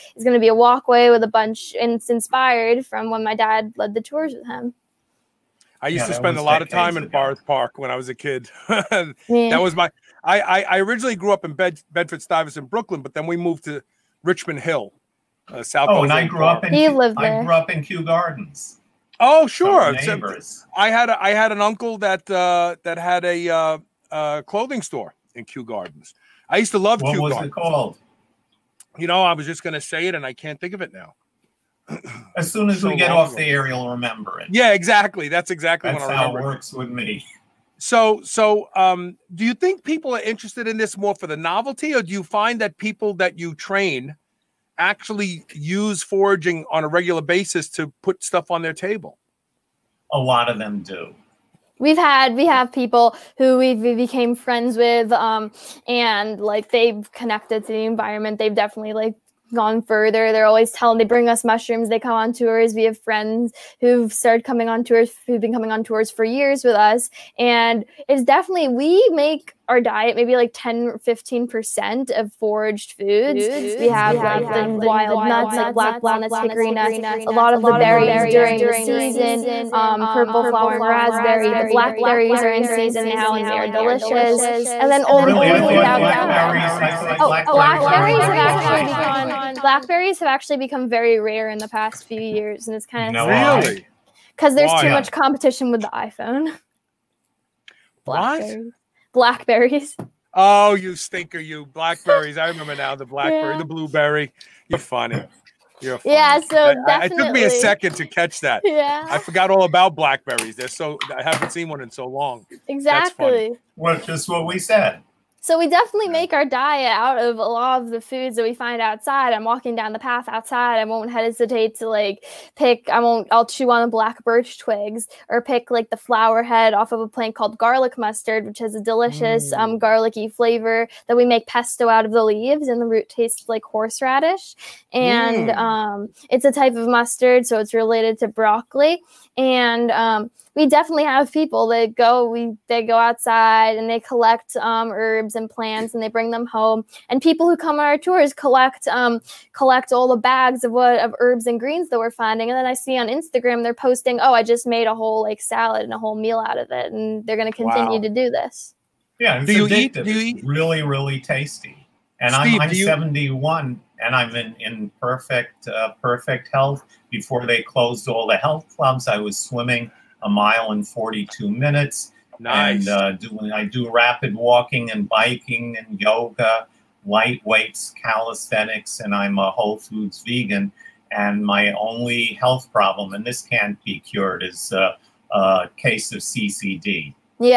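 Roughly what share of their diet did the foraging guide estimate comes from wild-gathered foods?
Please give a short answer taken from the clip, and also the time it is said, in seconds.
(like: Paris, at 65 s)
10 to 15%, at 70 s.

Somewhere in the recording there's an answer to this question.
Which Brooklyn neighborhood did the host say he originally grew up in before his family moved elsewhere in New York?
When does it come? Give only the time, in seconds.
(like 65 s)
11 s.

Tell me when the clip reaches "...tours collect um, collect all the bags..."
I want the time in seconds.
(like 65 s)
147 s.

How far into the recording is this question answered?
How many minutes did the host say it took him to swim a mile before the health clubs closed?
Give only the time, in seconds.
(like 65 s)
170 s.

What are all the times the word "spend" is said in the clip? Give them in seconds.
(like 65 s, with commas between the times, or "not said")
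6 s.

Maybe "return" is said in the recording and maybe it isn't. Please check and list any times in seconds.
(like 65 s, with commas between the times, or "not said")
not said.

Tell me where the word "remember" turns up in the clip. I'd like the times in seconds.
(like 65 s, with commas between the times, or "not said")
33 s, 102 s.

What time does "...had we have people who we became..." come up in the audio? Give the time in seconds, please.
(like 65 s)
51 s.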